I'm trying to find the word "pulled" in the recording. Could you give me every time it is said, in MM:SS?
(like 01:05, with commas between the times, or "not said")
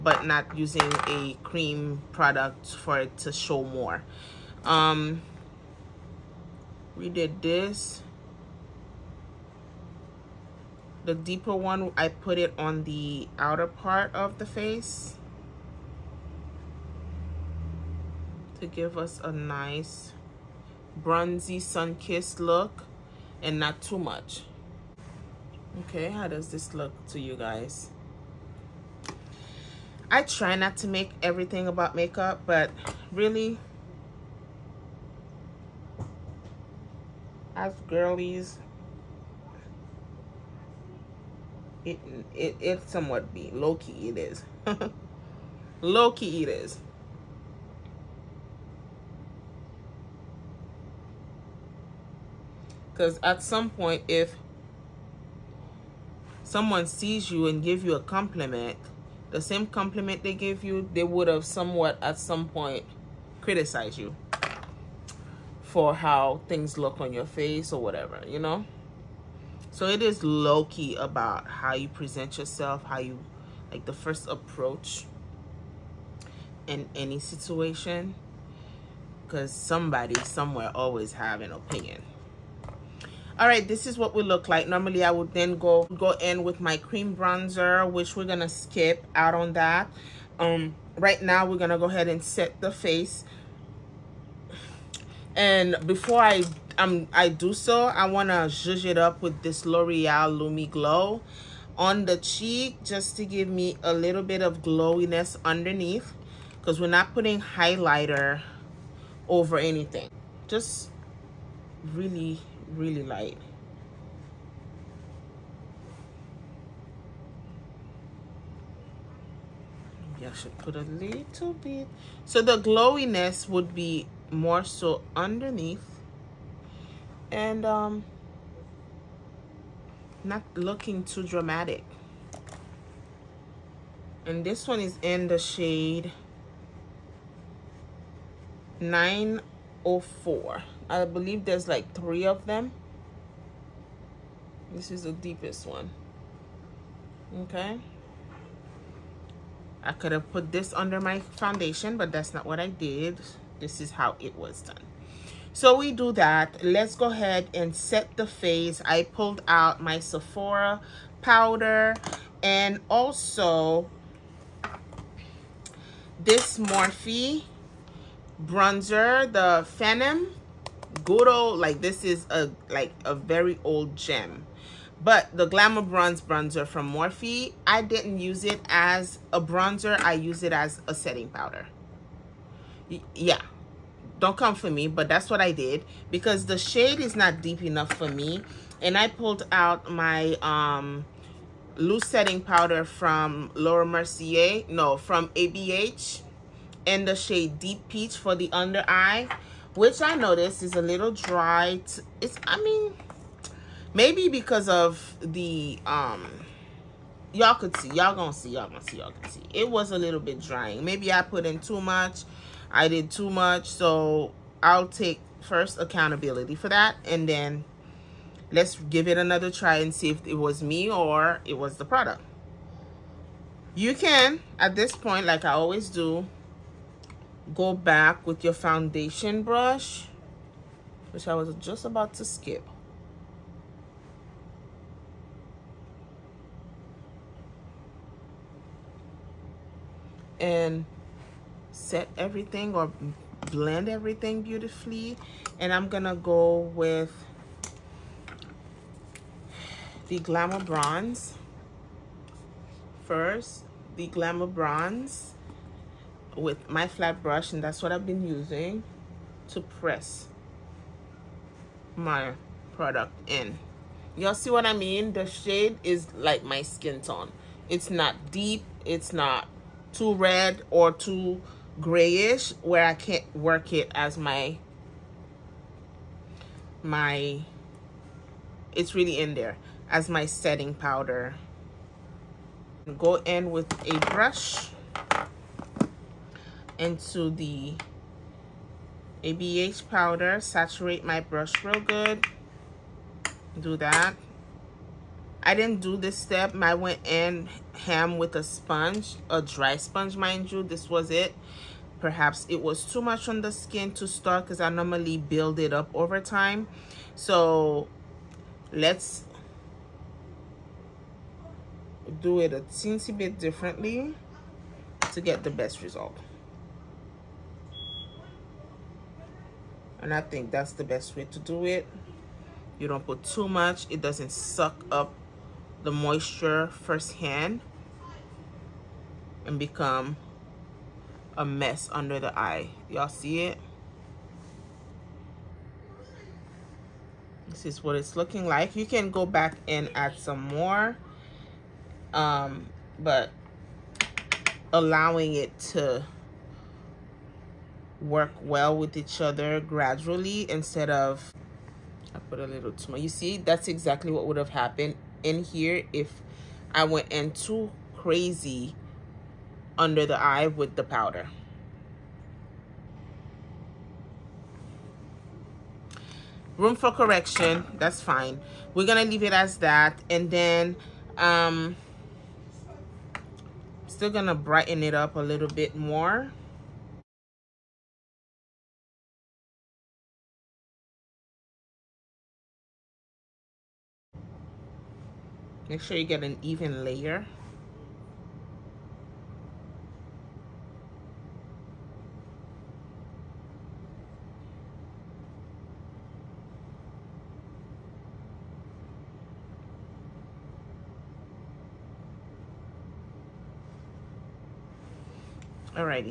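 02:39, 03:09.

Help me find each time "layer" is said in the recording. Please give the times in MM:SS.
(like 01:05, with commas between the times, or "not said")
06:26.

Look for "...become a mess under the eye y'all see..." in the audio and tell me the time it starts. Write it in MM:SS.
05:29.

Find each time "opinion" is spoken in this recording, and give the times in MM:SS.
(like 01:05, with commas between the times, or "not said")
01:21.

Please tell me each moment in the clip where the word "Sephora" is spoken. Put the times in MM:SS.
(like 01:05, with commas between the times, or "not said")
02:39.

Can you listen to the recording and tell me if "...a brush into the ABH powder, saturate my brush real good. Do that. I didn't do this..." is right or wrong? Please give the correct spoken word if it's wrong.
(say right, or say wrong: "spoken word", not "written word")
right.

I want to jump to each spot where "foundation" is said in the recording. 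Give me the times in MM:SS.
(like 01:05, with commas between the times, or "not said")
02:31, 03:48.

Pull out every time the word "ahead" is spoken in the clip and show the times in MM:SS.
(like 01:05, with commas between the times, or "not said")
01:31, 02:37.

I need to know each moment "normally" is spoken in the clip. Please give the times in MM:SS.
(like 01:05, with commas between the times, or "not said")
01:24, 05:04.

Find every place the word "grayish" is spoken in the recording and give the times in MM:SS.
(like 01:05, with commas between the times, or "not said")
04:31.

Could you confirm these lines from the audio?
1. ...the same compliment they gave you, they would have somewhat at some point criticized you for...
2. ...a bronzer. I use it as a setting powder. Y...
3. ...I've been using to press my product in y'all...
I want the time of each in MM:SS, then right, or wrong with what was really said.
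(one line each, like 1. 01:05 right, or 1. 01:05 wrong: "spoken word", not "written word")
1. 00:59 right
2. 02:59 right
3. 04:17 right.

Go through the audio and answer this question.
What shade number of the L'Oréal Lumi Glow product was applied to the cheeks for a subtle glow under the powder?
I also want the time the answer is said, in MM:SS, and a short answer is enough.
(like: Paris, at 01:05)
904, at 02:18.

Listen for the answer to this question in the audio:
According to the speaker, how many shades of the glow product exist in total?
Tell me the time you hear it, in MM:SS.
02:21.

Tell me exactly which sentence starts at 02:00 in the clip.
I should put a little bit.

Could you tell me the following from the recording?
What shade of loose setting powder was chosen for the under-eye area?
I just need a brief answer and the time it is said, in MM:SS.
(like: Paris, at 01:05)
Deep Peach, at 03:17.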